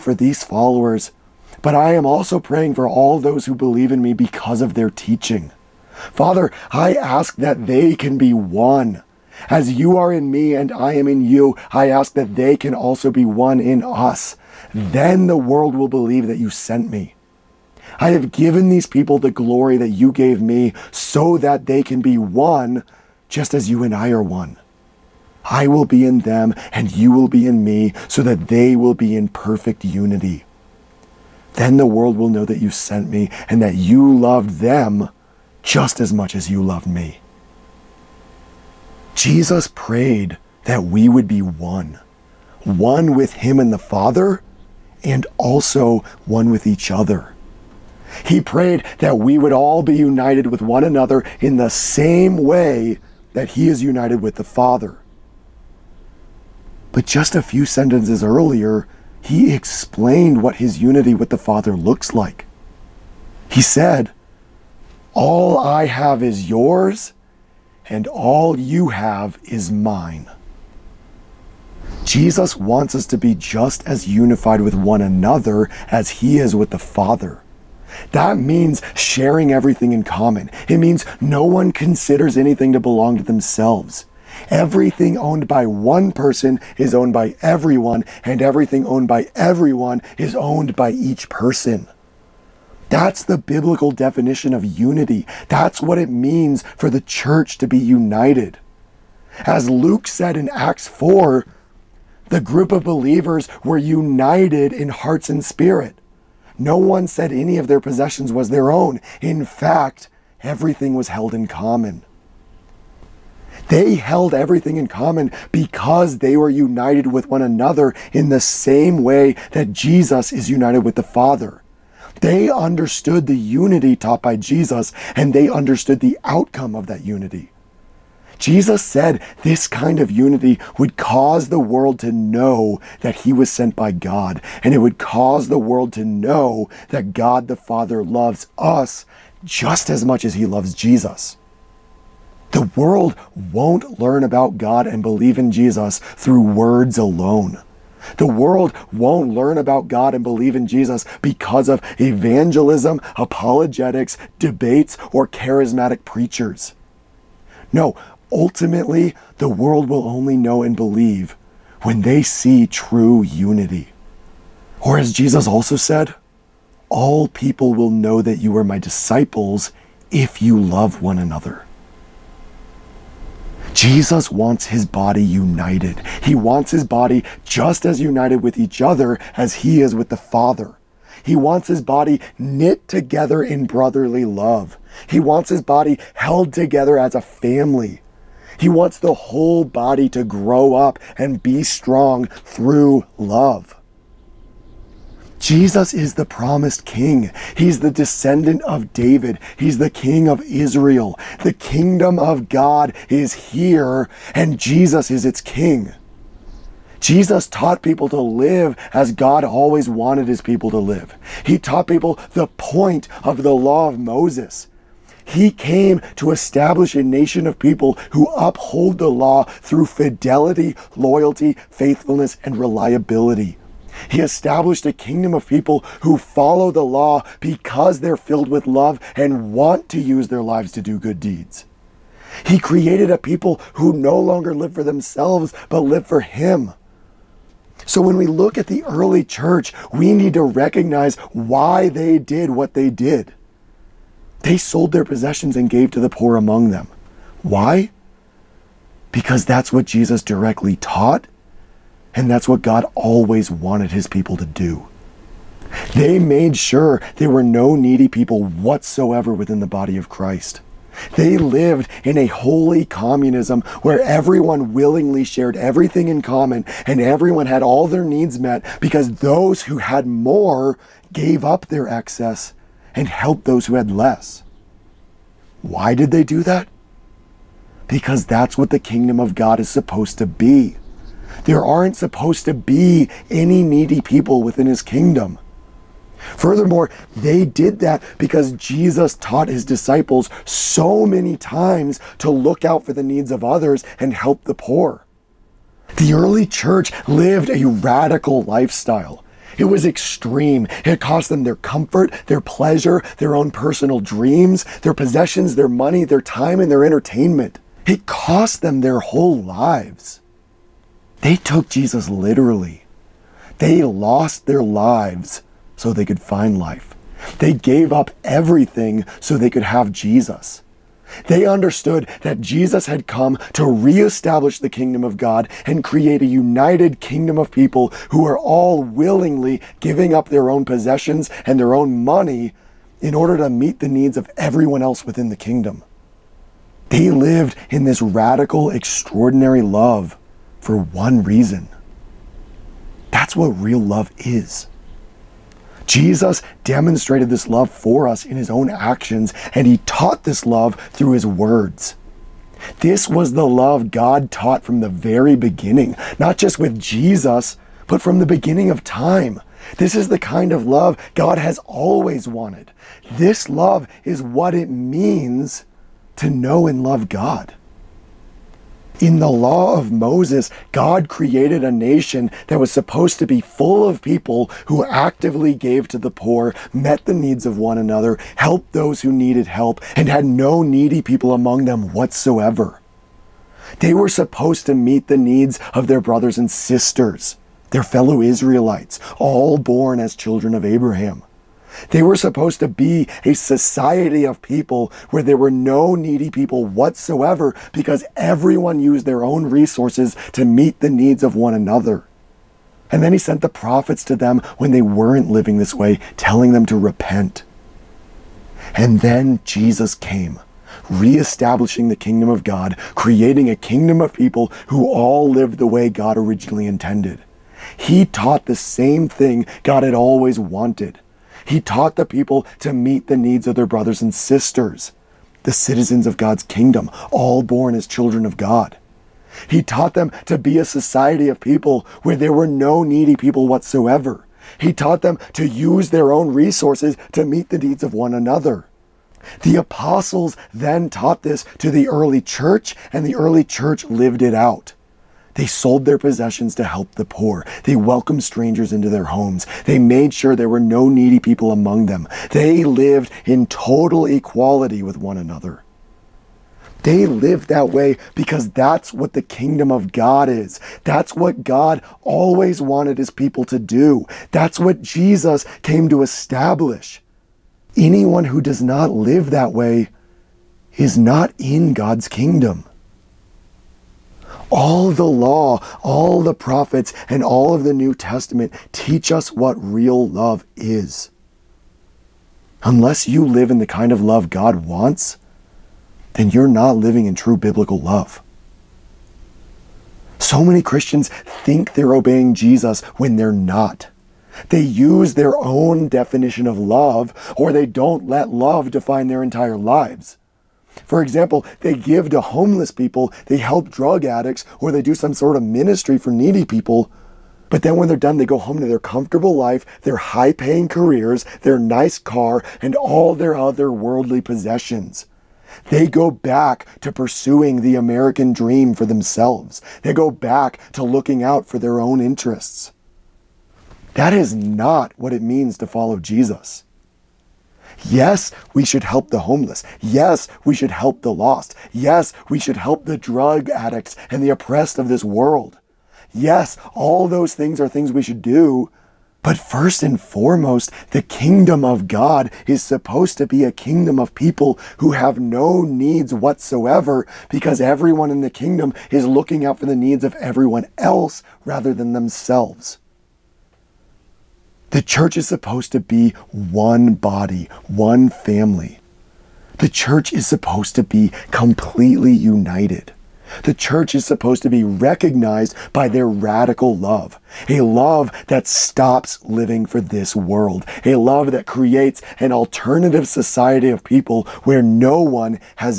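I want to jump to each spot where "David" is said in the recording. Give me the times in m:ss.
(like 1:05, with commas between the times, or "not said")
3:18.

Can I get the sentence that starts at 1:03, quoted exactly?
He said, all I have is yours, and all you have is mine.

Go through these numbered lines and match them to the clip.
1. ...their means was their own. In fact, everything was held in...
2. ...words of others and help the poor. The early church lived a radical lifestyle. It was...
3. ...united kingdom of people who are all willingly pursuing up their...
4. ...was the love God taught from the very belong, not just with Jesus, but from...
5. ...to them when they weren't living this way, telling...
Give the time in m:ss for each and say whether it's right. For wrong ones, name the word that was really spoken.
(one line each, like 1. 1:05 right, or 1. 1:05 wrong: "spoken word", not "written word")
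1. 1:47 wrong: "possessions", not "means"
2. 4:53 wrong: "needs", not "words"
3. 5:26 wrong: "giving", not "pursuing"
4. 5:53 wrong: "beginning", not "belong"
5. 6:44 right.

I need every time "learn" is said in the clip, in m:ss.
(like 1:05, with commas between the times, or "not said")
2:23, 2:29.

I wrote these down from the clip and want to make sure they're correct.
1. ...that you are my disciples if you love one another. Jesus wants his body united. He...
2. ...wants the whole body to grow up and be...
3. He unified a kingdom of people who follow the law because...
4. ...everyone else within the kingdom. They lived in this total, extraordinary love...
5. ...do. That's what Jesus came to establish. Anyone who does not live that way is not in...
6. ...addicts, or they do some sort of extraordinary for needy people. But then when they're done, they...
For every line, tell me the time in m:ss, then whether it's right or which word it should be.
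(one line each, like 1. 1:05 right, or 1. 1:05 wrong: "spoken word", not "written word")
1. 2:48 right
2. 3:08 right
3. 3:44 wrong: "established", not "unified"
4. 5:34 wrong: "radical", not "total"
5. 7:43 right
6. 8:24 wrong: "ministry", not "extraordinary".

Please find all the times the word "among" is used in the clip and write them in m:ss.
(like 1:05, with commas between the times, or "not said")
4:06, 6:21, 7:31.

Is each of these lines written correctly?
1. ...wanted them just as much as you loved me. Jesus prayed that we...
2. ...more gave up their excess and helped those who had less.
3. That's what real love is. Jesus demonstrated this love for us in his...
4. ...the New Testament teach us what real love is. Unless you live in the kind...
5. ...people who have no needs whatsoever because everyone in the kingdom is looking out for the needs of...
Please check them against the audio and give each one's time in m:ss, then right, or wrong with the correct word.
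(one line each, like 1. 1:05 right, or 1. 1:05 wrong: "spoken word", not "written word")
1. 0:34 wrong: "loved", not "wanted"
2. 4:30 right
3. 5:43 right
4. 7:57 right
5. 9:04 right.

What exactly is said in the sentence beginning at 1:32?
That's the biblical definition of unity.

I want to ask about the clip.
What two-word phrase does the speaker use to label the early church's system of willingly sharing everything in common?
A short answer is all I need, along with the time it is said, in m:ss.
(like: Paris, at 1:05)
holy communism, at 4:22.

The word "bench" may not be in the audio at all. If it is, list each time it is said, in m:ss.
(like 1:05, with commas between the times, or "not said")
not said.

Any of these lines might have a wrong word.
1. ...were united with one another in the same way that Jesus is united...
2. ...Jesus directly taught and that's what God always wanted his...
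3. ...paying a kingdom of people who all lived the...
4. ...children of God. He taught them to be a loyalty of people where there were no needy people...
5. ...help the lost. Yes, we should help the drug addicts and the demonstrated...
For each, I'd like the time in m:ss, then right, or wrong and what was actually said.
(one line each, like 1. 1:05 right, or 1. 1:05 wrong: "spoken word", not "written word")
1. 1:56 right
2. 4:09 right
3. 6:52 wrong: "creating", not "paying"
4. 7:07 wrong: "society", not "loyalty"
5. 8:50 wrong: "oppressed", not "demonstrated".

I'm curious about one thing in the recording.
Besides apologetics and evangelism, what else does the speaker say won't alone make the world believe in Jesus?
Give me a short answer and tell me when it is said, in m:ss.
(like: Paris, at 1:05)
debates, at 2:34.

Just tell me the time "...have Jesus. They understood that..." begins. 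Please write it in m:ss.
5:19.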